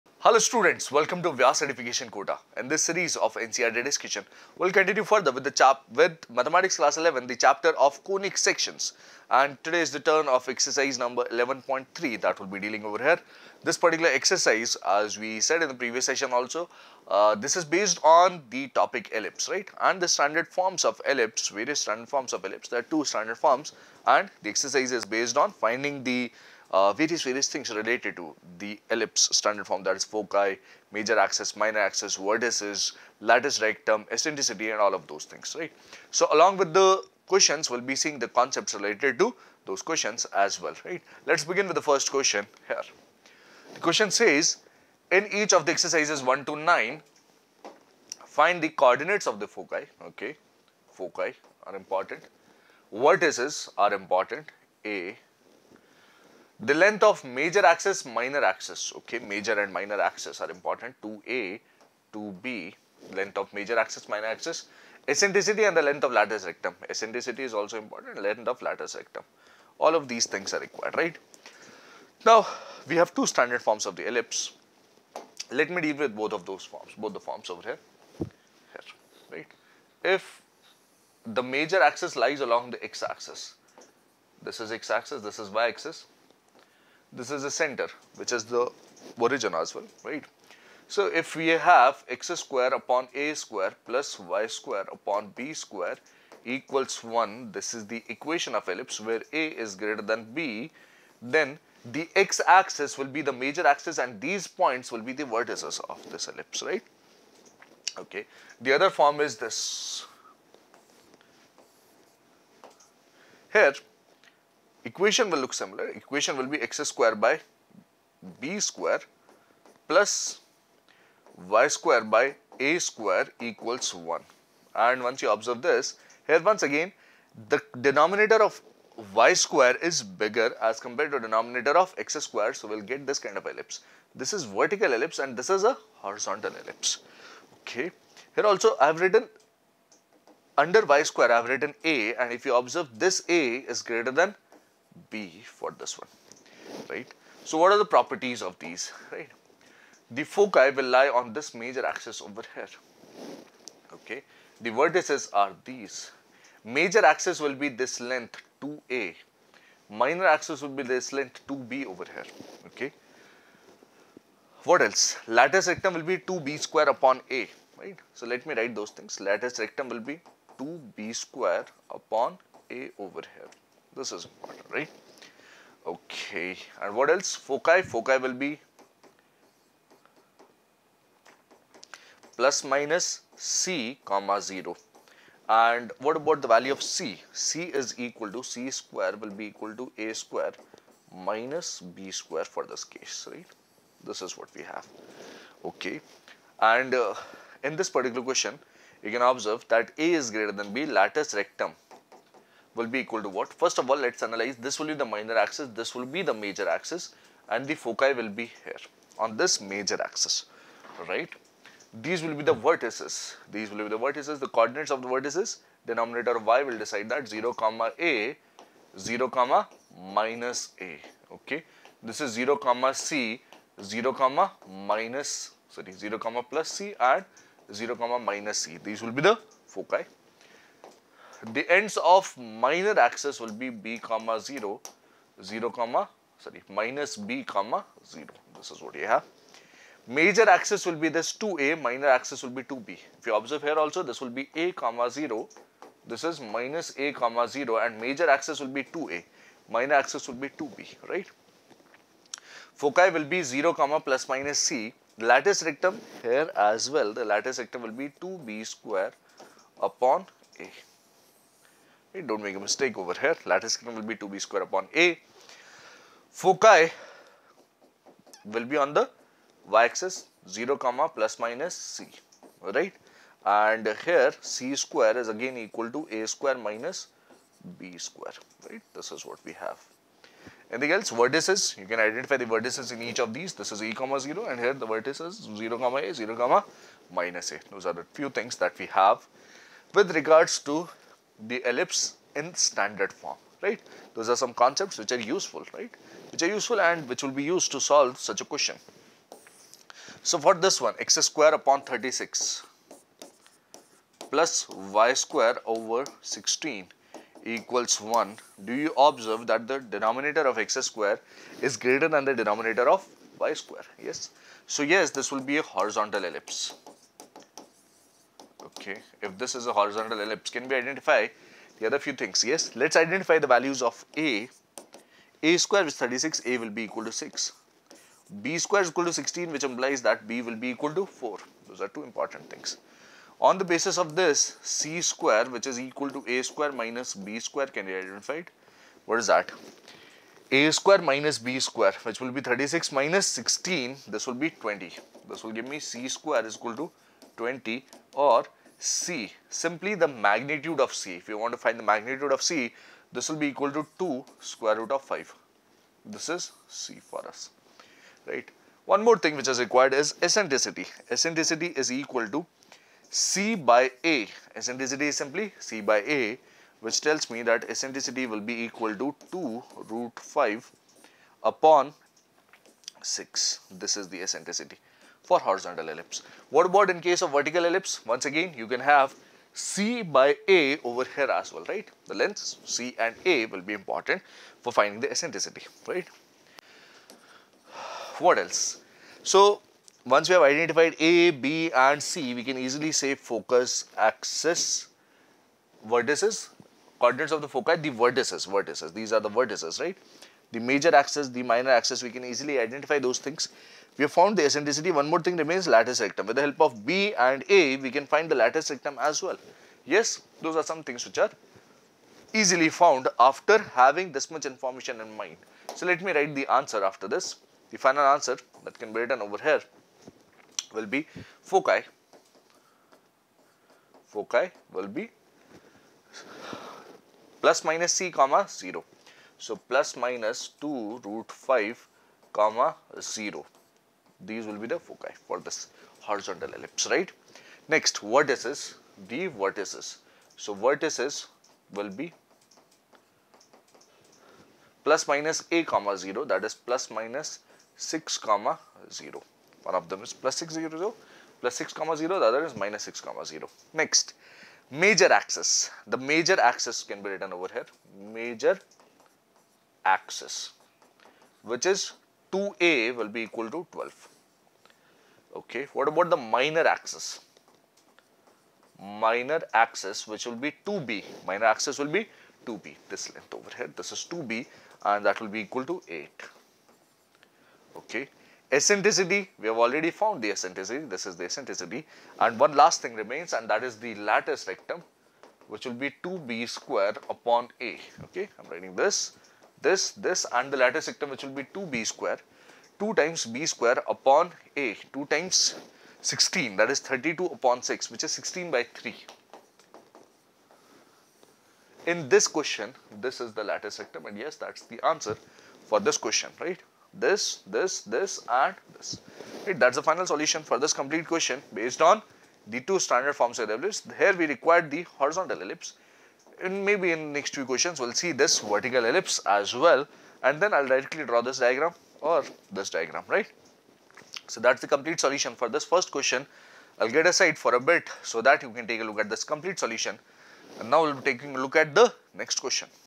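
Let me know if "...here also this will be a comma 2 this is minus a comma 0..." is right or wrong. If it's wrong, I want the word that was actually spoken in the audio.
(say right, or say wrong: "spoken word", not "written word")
wrong: "0", not "2".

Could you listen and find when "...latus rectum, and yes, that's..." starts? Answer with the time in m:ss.
8:23.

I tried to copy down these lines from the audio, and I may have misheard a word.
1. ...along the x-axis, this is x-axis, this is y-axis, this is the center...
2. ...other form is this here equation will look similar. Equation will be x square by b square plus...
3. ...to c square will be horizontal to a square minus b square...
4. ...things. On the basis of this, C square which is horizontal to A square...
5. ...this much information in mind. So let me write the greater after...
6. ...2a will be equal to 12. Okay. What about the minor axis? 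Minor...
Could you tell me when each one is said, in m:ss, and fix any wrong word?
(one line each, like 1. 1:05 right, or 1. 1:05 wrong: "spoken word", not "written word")
1. 1:22 right
2. 1:48 right
3. 3:08 wrong: "equal", not "horizontal"
4. 5:32 wrong: "equal", not "horizontal"
5. 6:54 wrong: "answer", not "greater"
6. 7:42 right.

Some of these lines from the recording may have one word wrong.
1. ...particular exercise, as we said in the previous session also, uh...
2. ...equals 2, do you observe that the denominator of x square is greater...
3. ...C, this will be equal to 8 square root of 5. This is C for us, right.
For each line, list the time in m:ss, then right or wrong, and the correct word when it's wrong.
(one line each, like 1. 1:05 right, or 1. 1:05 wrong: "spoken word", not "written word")
1. 0:13 right
2. 5:07 wrong: "1", not "2"
3. 5:52 wrong: "2", not "8".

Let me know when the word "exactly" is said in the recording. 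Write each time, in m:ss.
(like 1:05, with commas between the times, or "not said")
not said.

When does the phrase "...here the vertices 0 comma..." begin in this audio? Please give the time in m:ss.
4:44.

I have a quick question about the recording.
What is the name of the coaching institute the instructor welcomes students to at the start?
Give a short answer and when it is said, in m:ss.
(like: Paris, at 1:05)
Vyas Edification Kota, at 0:01.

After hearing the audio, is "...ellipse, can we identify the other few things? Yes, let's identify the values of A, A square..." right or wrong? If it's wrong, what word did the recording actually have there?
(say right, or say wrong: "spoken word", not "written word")
right.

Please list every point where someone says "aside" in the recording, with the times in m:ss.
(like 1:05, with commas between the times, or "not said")
8:47.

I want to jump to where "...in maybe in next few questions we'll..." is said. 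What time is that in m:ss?
8:36.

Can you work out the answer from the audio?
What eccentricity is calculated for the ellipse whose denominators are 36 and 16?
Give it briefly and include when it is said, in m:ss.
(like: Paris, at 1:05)
2√5/6, at 6:09.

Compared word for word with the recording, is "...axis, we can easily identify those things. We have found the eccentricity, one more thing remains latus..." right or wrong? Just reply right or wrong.
right.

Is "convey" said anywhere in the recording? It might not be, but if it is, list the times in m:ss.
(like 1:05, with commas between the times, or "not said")
not said.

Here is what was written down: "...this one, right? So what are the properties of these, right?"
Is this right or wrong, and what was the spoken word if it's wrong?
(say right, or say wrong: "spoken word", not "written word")
right.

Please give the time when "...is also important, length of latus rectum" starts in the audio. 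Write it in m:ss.
1:07.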